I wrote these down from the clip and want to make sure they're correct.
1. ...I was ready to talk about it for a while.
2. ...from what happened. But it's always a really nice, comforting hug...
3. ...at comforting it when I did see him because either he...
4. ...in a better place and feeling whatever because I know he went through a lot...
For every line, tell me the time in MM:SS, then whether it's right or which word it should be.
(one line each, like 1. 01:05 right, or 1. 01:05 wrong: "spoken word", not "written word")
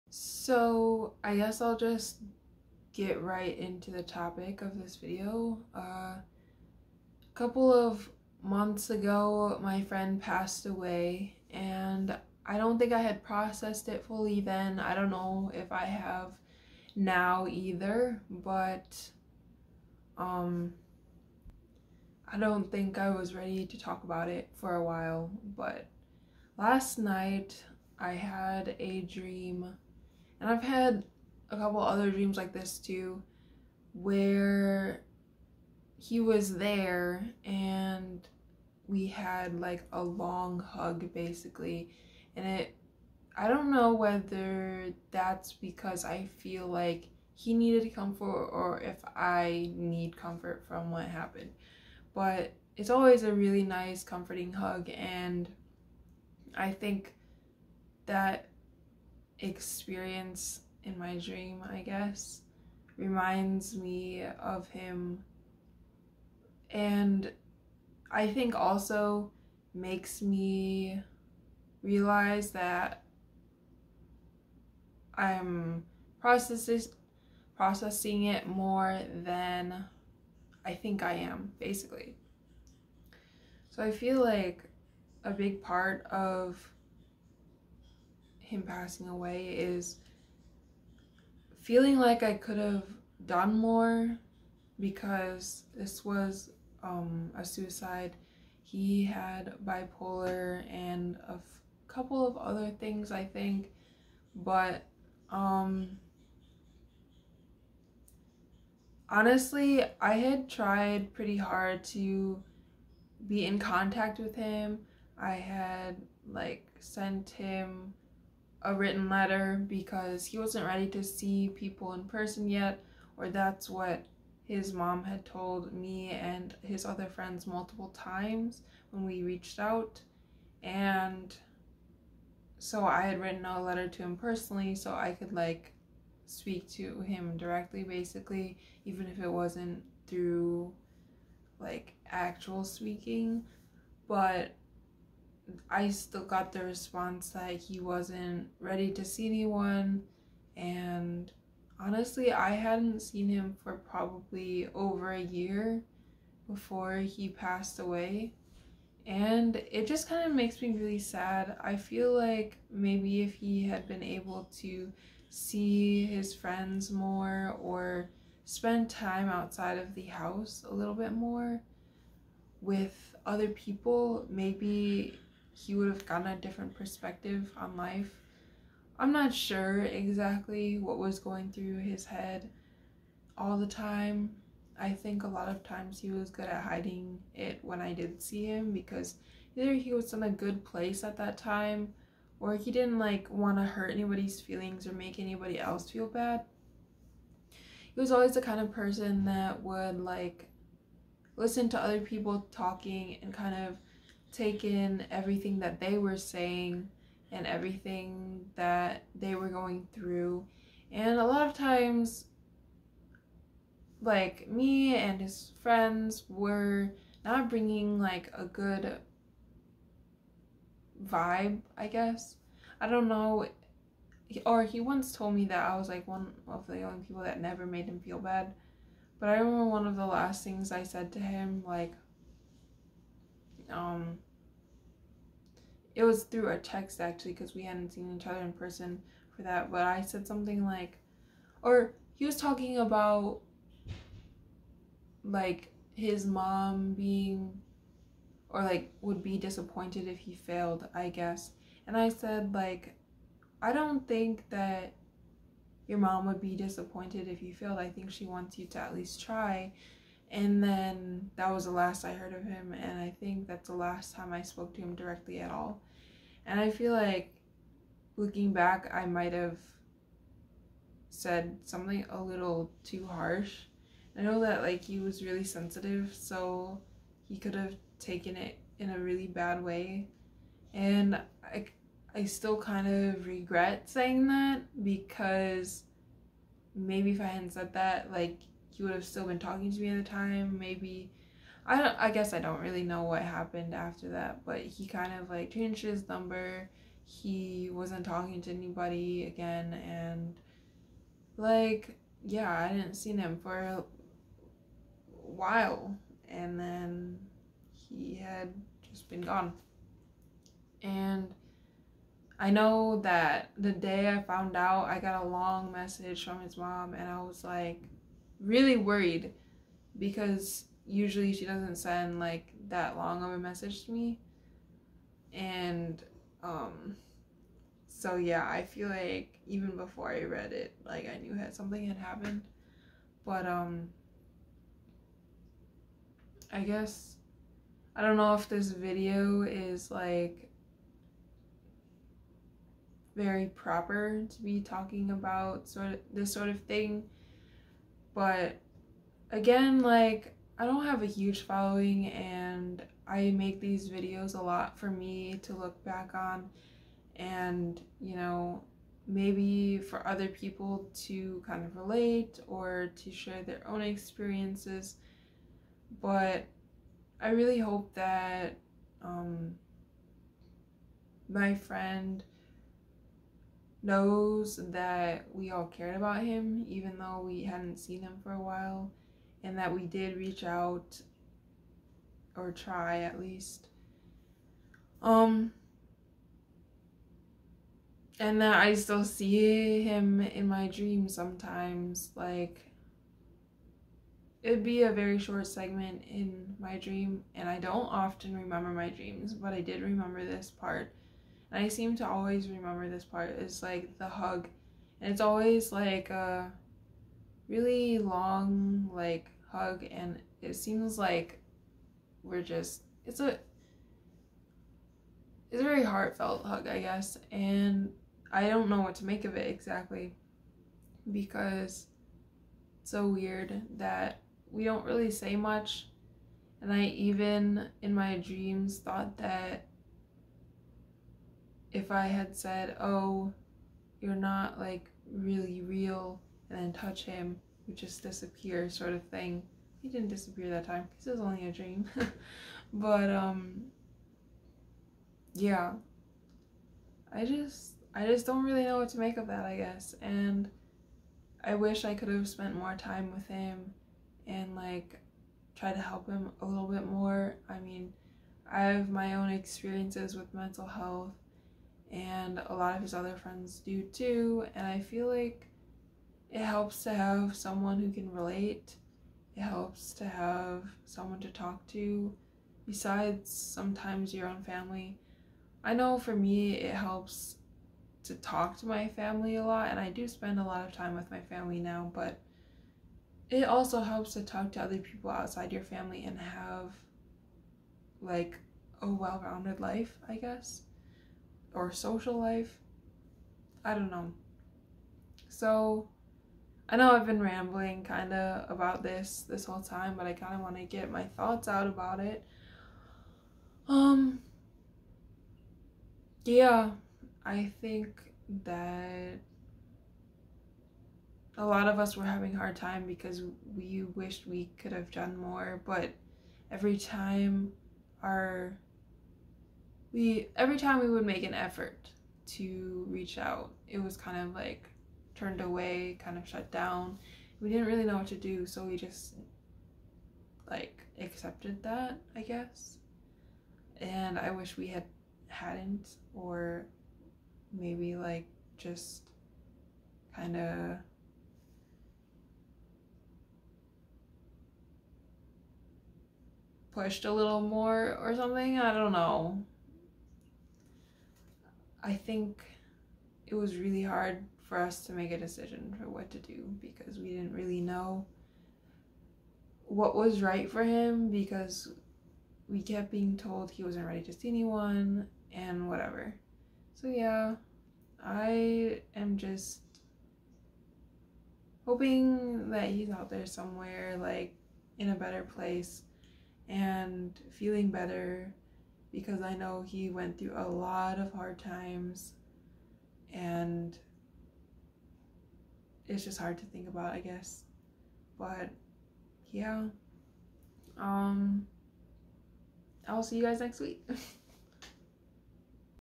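1. 00:22 right
2. 00:50 right
3. 03:06 wrong: "hiding", not "comforting"
4. 09:34 wrong: "better", not "whatever".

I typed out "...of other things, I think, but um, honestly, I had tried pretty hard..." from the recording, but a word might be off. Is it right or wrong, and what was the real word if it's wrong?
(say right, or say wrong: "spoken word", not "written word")
right.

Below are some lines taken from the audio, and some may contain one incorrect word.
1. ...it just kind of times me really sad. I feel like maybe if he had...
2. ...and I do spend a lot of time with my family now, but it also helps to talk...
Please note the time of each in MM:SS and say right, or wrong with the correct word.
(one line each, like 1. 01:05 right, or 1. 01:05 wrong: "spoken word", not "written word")
1. 02:39 wrong: "makes", not "times"
2. 07:59 right.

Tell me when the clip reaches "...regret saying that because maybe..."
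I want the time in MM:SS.
04:43.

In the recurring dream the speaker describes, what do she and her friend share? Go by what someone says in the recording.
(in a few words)
a long hug.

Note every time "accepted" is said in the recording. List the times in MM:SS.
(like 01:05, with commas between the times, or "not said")
08:50.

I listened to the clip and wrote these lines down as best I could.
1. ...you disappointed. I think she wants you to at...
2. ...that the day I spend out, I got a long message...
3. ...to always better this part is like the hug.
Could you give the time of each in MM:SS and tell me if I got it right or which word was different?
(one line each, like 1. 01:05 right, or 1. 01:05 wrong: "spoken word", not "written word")
1. 04:17 wrong: "failed", not "disappointed"
2. 05:13 wrong: "found", not "spend"
3. 06:41 wrong: "remember", not "better".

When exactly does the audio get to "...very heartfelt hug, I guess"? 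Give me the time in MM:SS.
06:55.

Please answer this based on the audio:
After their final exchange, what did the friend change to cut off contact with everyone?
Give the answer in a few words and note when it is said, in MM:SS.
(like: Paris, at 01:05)
his number, at 04:55.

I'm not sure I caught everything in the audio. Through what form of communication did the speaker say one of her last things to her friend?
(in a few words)
a text.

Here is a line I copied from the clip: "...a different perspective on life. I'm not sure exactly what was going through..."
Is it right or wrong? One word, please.
right.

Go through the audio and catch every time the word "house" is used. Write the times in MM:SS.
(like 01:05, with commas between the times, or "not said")
02:50.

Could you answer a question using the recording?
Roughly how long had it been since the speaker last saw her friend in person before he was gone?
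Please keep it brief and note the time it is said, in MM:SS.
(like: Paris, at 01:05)
over a year, at 02:34.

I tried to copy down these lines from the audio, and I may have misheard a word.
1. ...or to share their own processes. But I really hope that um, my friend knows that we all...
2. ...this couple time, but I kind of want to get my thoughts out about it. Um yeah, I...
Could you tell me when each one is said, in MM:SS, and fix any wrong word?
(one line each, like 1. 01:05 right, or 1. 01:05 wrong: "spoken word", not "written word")
1. 06:02 wrong: "experiences", not "processes"
2. 08:19 wrong: "whole", not "couple".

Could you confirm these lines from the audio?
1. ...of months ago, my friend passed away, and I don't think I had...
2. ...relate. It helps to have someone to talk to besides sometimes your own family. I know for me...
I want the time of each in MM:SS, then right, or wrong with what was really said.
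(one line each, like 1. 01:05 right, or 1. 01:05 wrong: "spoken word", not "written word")
1. 00:07 right
2. 07:48 right.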